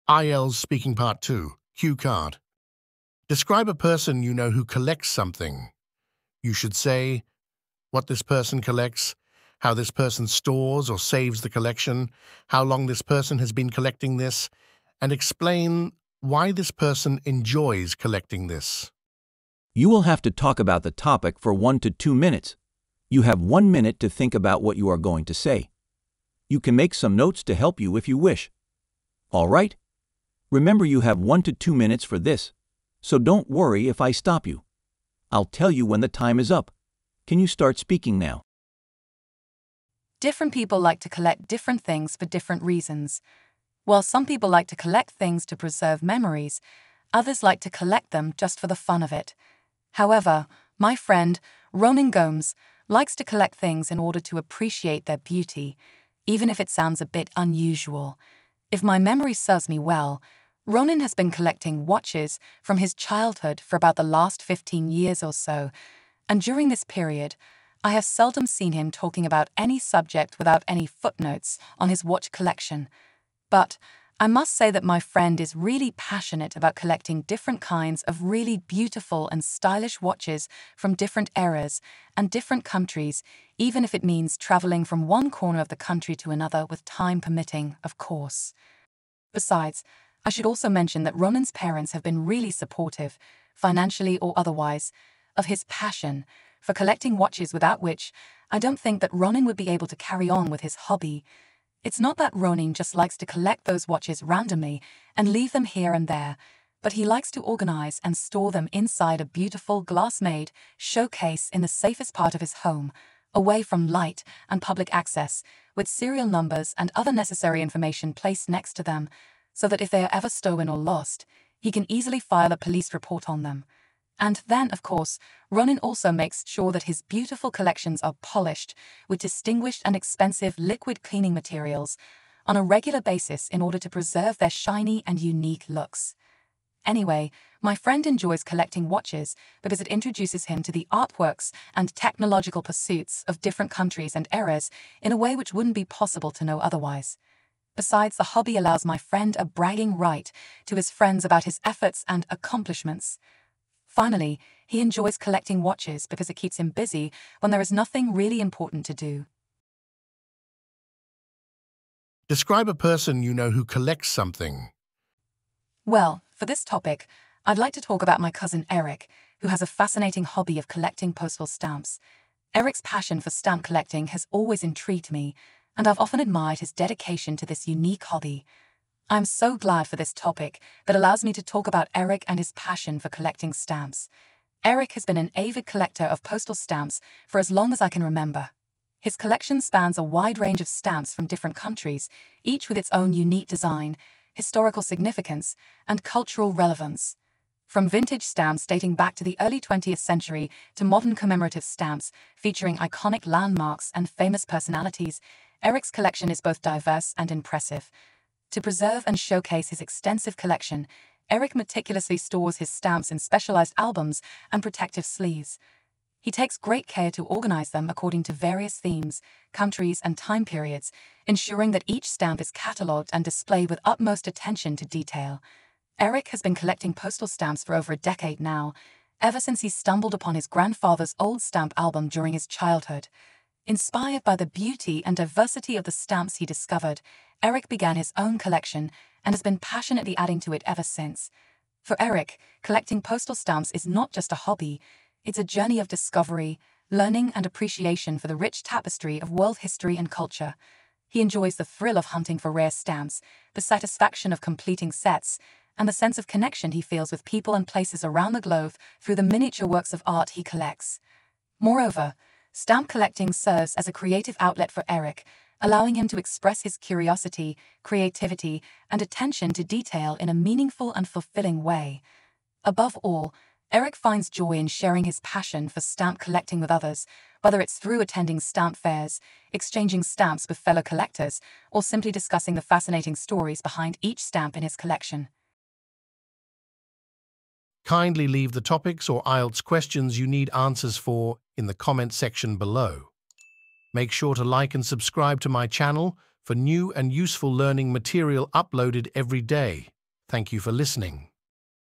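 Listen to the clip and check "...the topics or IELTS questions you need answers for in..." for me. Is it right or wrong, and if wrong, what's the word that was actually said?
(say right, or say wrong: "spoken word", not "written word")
right.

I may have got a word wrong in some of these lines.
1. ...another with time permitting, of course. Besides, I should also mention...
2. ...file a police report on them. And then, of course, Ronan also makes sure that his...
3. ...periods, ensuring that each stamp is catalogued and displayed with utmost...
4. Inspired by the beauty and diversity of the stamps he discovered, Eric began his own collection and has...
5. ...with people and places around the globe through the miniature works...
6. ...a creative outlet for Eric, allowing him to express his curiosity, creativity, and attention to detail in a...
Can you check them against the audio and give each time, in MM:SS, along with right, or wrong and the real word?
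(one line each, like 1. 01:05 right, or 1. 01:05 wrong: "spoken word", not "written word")
1. 01:26 right
2. 02:02 right
3. 03:40 right
4. 03:53 right
5. 04:17 right
6. 04:23 right.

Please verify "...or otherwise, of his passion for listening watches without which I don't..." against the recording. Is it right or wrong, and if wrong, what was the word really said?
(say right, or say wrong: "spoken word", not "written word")
wrong: "collecting", not "listening".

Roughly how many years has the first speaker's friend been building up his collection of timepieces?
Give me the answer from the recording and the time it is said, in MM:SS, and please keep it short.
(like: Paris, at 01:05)
15 years, at 01:04.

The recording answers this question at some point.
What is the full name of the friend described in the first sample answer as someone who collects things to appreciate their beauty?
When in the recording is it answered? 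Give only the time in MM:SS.
00:51.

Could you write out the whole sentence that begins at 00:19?
You will have to talk about the topic for one to two minutes.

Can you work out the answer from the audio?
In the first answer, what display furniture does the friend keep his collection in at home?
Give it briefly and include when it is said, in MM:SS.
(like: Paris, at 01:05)
glass-made showcase, at 01:49.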